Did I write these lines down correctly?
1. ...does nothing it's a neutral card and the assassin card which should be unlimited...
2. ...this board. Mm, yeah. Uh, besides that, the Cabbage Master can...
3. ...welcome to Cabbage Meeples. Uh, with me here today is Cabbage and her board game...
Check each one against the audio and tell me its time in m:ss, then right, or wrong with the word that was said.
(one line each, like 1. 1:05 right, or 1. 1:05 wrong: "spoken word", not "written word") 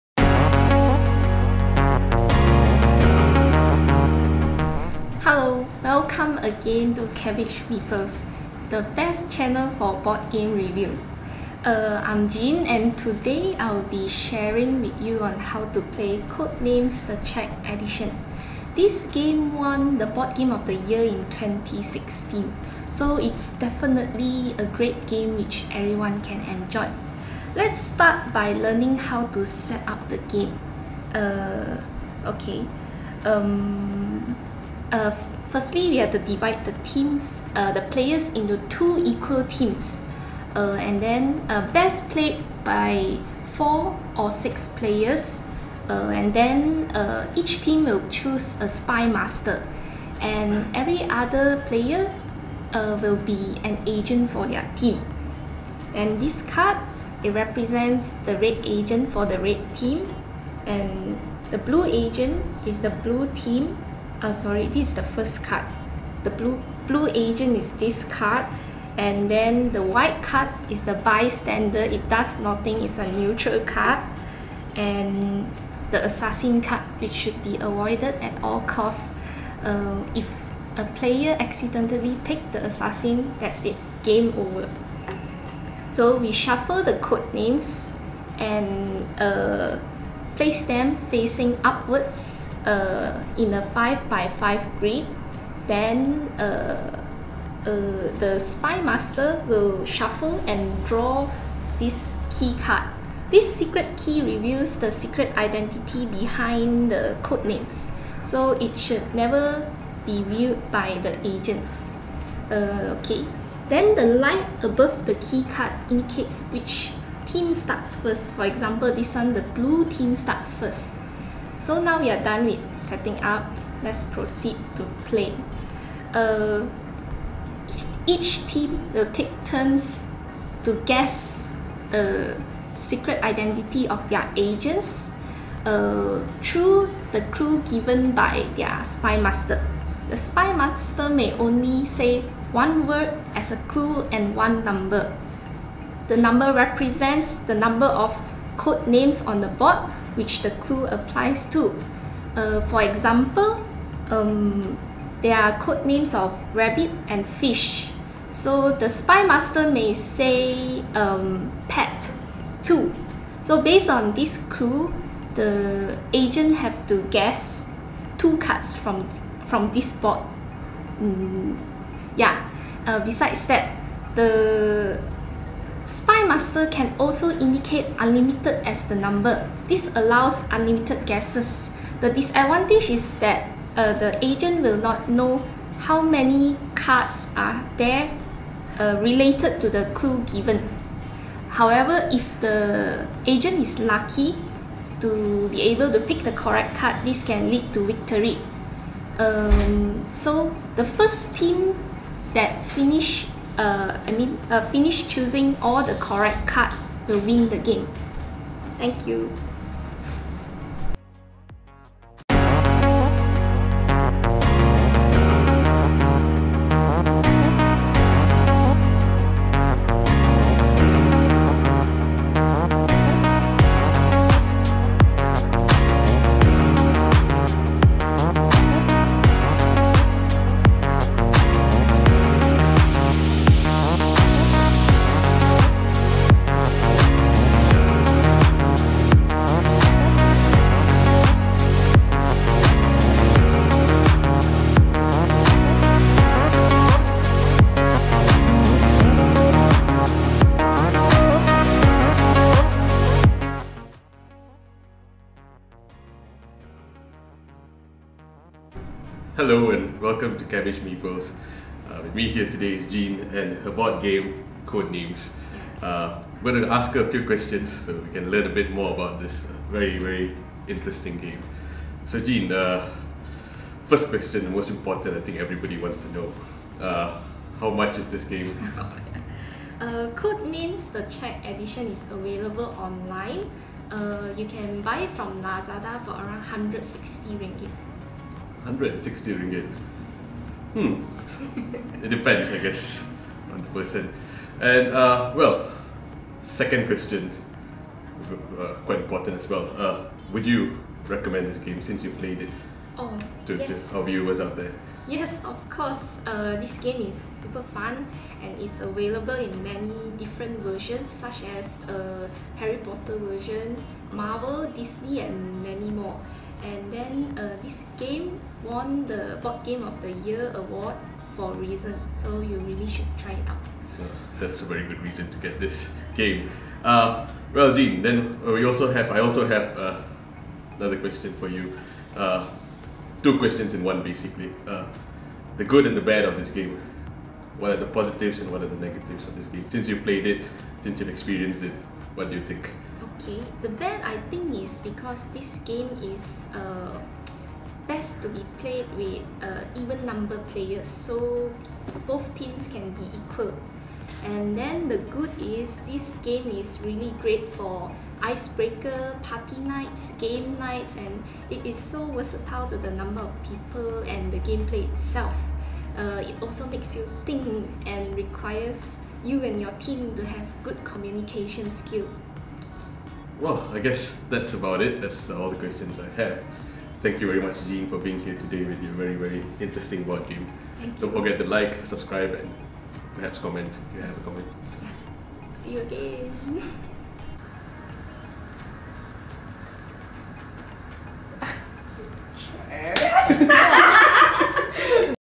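1. 1:12 wrong: "avoided", not "unlimited"
2. 2:49 wrong: "Spy", not "Cabbage"
3. 4:19 wrong: "Jean", not "Cabbage".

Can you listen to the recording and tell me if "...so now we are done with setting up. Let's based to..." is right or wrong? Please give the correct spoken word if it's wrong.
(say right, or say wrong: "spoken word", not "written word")
wrong: "proceed", not "based".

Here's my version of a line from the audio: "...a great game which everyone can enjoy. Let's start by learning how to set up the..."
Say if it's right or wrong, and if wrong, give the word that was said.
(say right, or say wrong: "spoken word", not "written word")
right.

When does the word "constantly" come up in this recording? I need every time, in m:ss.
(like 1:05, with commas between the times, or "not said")
not said.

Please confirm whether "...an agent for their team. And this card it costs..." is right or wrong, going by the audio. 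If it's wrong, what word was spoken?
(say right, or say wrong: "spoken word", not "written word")
wrong: "represents", not "costs".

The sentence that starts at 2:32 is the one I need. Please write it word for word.
Uh, for example, um, there are code names of rabbit and fish.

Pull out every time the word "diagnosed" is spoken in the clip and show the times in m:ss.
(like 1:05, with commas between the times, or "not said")
not said.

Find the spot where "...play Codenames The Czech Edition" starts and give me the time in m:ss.
0:15.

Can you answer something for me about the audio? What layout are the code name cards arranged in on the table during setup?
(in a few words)
5 by 5 grid.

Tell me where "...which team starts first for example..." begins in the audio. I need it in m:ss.
1:56.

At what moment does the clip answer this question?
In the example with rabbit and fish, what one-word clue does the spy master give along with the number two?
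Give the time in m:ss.
2:41.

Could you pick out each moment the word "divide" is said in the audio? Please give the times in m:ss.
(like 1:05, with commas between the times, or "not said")
0:36.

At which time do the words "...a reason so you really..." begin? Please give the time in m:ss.
5:21.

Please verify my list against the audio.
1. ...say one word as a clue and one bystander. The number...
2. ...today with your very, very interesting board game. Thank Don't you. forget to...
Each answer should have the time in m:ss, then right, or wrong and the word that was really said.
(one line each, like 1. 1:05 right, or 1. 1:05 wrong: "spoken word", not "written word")
1. 2:21 wrong: "number", not "bystander"
2. 6:18 right.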